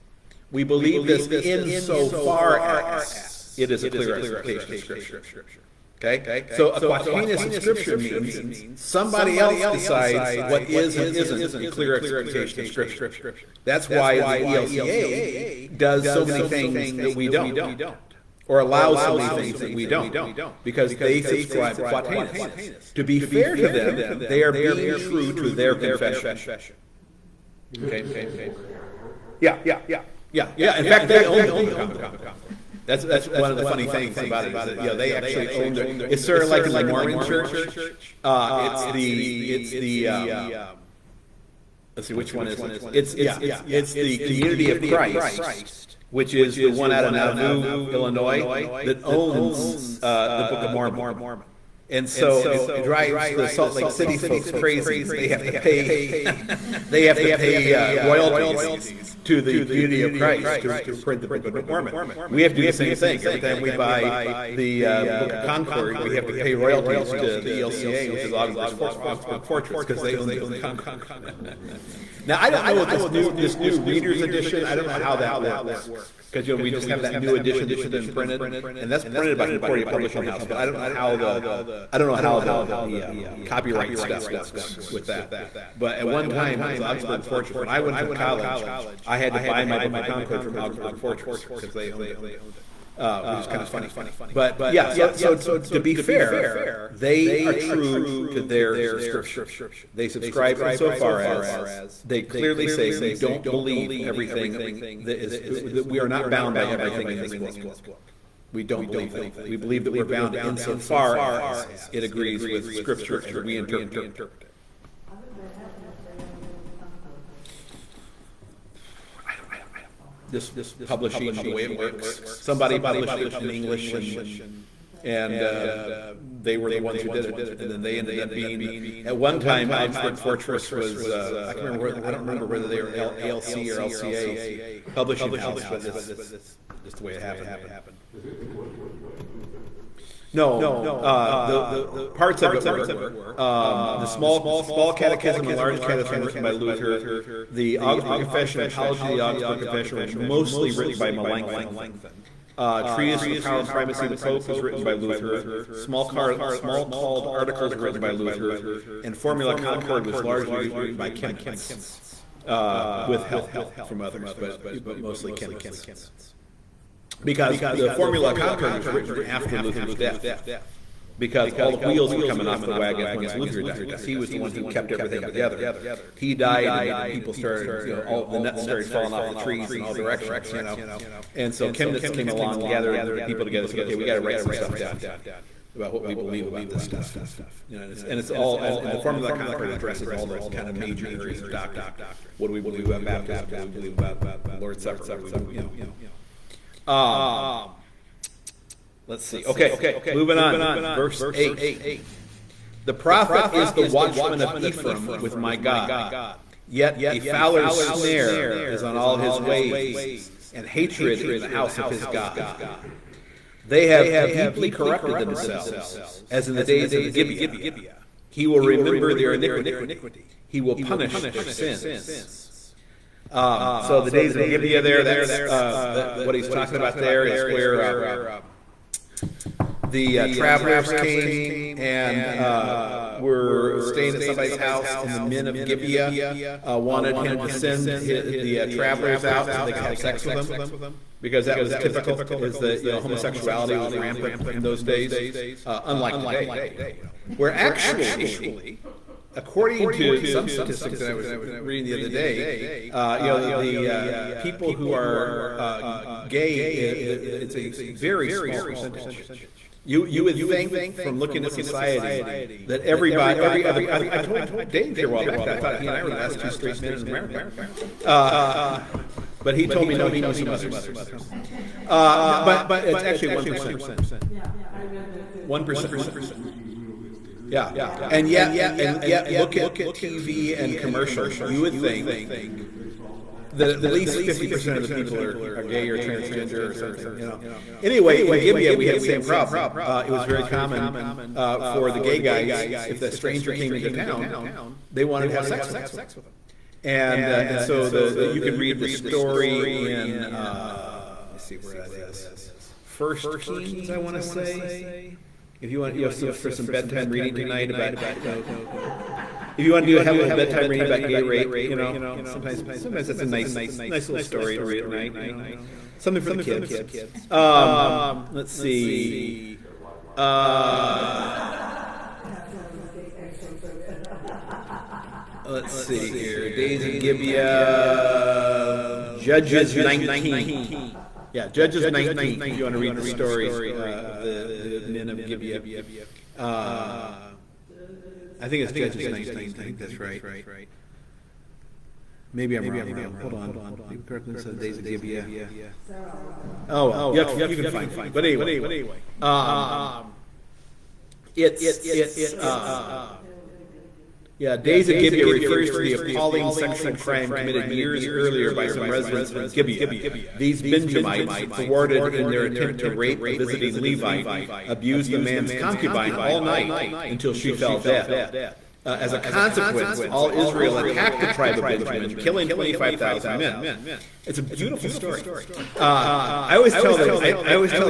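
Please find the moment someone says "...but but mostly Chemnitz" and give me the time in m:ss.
2:44.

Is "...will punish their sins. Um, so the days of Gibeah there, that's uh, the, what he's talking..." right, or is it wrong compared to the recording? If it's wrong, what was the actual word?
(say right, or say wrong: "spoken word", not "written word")
right.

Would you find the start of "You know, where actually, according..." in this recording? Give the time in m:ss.
4:06.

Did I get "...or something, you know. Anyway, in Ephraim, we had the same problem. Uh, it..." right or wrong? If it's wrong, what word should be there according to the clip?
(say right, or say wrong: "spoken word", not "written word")
wrong: "Gibeah", not "Ephraim".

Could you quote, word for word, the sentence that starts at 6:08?
Uh, as a consequence, all Israel attacked the tribe of Benjamin, killing 25,000 men.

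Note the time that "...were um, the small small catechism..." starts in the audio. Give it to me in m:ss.
2:22.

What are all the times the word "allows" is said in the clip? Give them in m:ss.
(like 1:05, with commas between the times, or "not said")
0:18.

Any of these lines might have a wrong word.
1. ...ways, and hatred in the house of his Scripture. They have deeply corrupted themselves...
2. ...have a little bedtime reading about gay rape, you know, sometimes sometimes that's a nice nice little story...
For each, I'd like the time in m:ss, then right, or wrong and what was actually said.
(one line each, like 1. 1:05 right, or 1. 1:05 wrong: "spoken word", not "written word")
1. 3:29 wrong: "God", not "Scripture"
2. 5:09 right.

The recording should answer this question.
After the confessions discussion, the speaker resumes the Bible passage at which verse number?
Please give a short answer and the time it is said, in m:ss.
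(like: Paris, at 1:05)
8, at 3:20.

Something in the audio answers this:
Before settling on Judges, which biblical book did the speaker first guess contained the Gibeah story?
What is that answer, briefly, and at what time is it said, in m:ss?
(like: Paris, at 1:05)
First Kings, at 5:02.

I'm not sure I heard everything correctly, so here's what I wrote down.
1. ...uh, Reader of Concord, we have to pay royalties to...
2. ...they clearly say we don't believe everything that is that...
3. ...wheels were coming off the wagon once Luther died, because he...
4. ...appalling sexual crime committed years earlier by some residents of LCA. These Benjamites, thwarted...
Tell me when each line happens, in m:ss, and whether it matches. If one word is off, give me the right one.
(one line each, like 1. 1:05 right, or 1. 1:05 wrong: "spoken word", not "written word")
1. 1:04 wrong: "Book", not "Reader"
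2. 1:42 right
3. 2:51 right
4. 5:55 wrong: "Gibeah", not "LCA".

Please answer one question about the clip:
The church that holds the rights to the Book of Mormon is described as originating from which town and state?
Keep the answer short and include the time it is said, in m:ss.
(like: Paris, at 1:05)
Nauvoo, Illinois, at 0:47.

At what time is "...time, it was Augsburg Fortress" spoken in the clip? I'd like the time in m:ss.
1:26.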